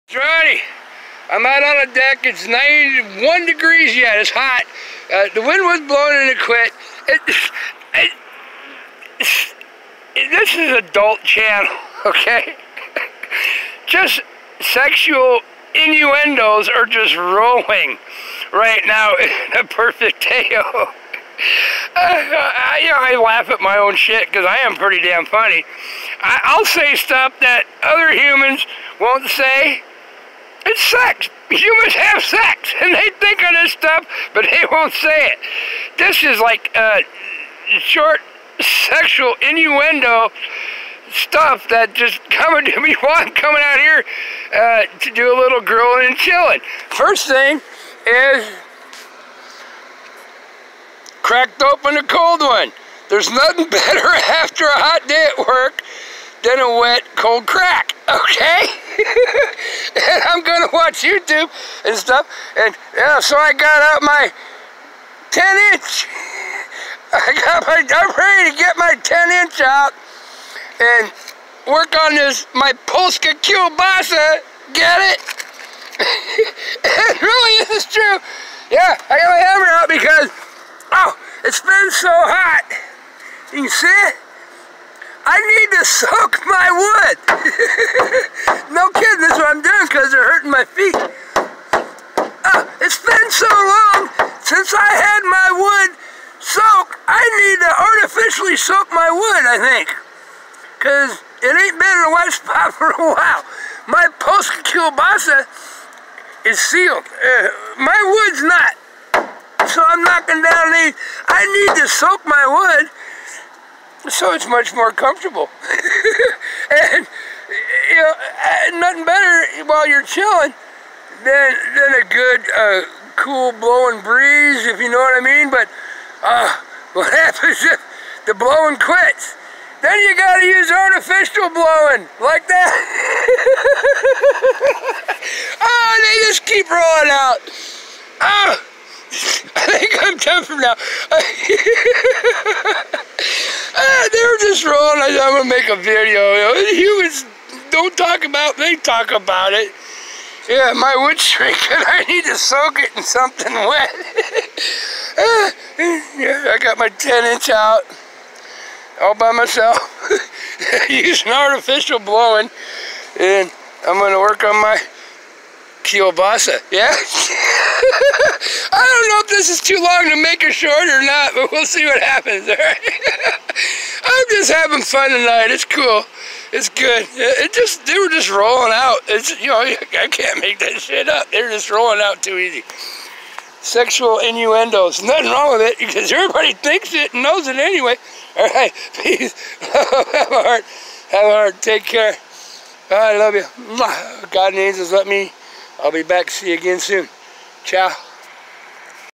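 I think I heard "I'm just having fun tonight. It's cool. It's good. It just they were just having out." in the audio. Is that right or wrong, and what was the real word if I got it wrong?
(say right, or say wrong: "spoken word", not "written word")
wrong: "rolling", not "having".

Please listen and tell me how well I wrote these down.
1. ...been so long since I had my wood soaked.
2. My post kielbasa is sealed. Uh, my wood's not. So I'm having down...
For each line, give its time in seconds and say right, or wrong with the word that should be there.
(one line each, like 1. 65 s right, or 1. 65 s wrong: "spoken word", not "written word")
1. 93 s right
2. 103 s wrong: "knocking", not "having".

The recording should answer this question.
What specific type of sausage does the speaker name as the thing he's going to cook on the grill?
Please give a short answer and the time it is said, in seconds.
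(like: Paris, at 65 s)
Polska Kielbasa, at 72 s.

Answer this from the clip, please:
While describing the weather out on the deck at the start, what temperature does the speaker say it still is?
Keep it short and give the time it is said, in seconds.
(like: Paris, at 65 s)
91 degrees, at 2 s.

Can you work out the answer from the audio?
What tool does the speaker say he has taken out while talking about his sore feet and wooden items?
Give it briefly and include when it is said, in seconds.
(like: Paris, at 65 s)
hammer, at 79 s.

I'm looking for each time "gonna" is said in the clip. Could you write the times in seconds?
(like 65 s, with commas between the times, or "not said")
60 s, 145 s, 163 s.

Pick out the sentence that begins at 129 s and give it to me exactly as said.
Then you gotta use artificial blowing like that.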